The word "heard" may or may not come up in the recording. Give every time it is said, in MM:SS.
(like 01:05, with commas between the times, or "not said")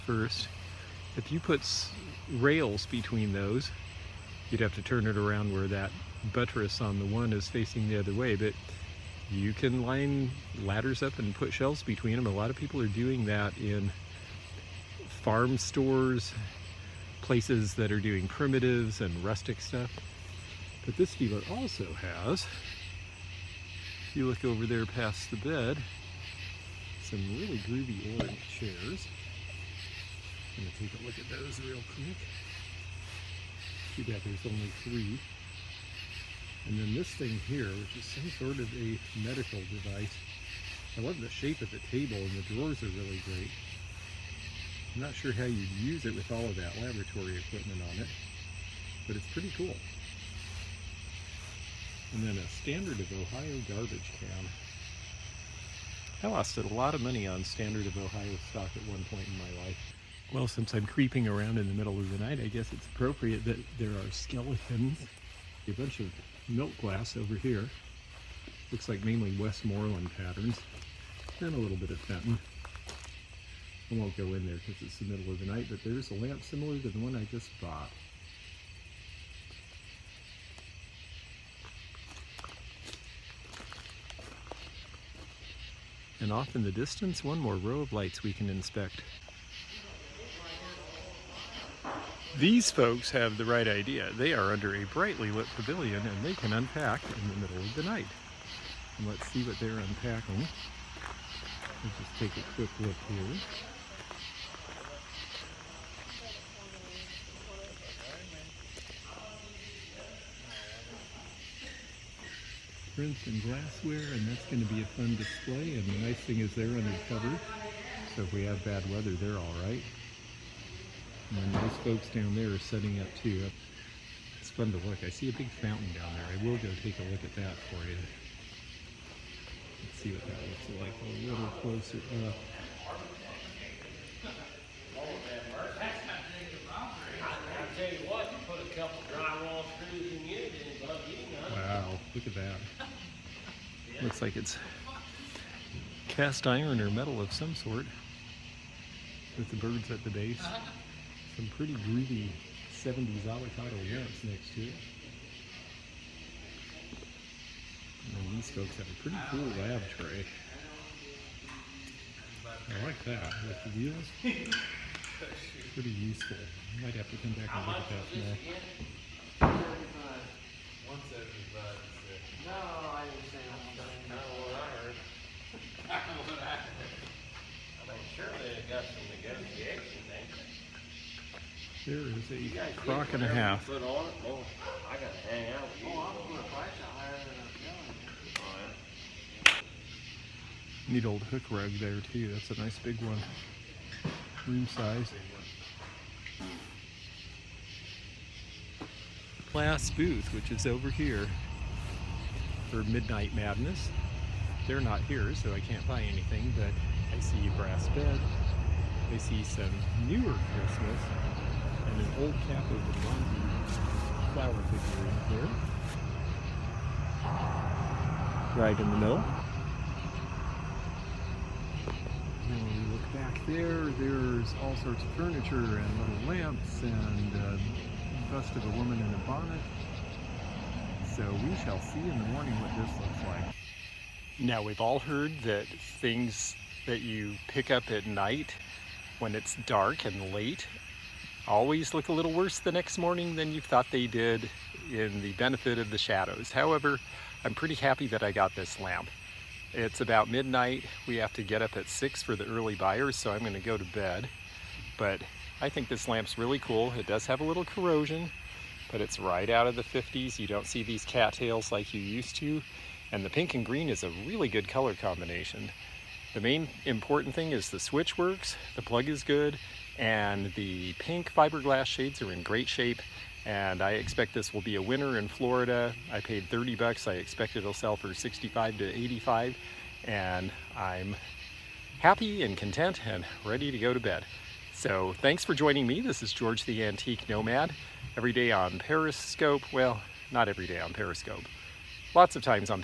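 02:54, 03:54.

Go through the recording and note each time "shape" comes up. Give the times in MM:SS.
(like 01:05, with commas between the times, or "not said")
00:41, 04:32.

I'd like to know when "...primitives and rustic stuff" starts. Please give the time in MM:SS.
00:18.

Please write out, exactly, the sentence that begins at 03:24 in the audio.
They're not here, so I can't buy anything, but I see a brass bed.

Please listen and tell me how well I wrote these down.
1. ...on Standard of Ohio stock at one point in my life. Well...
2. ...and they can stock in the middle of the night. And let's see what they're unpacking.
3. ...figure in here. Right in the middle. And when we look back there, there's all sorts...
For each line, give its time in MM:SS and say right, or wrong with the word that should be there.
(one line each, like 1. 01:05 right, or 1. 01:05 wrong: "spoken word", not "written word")
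1. 00:57 right
2. 01:36 wrong: "unpack", not "stock"
3. 03:34 right.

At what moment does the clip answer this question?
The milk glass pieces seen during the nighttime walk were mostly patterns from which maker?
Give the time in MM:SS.
01:09.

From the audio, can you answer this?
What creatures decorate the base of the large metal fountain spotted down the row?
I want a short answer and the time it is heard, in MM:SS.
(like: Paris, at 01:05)
birds, at 02:29.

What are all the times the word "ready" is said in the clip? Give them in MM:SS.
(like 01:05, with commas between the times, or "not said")
04:43.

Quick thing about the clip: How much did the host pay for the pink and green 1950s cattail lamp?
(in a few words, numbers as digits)
$30.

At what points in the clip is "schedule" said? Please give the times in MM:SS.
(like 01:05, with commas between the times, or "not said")
not said.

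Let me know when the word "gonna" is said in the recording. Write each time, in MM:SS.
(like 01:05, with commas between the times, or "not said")
00:30, 04:13.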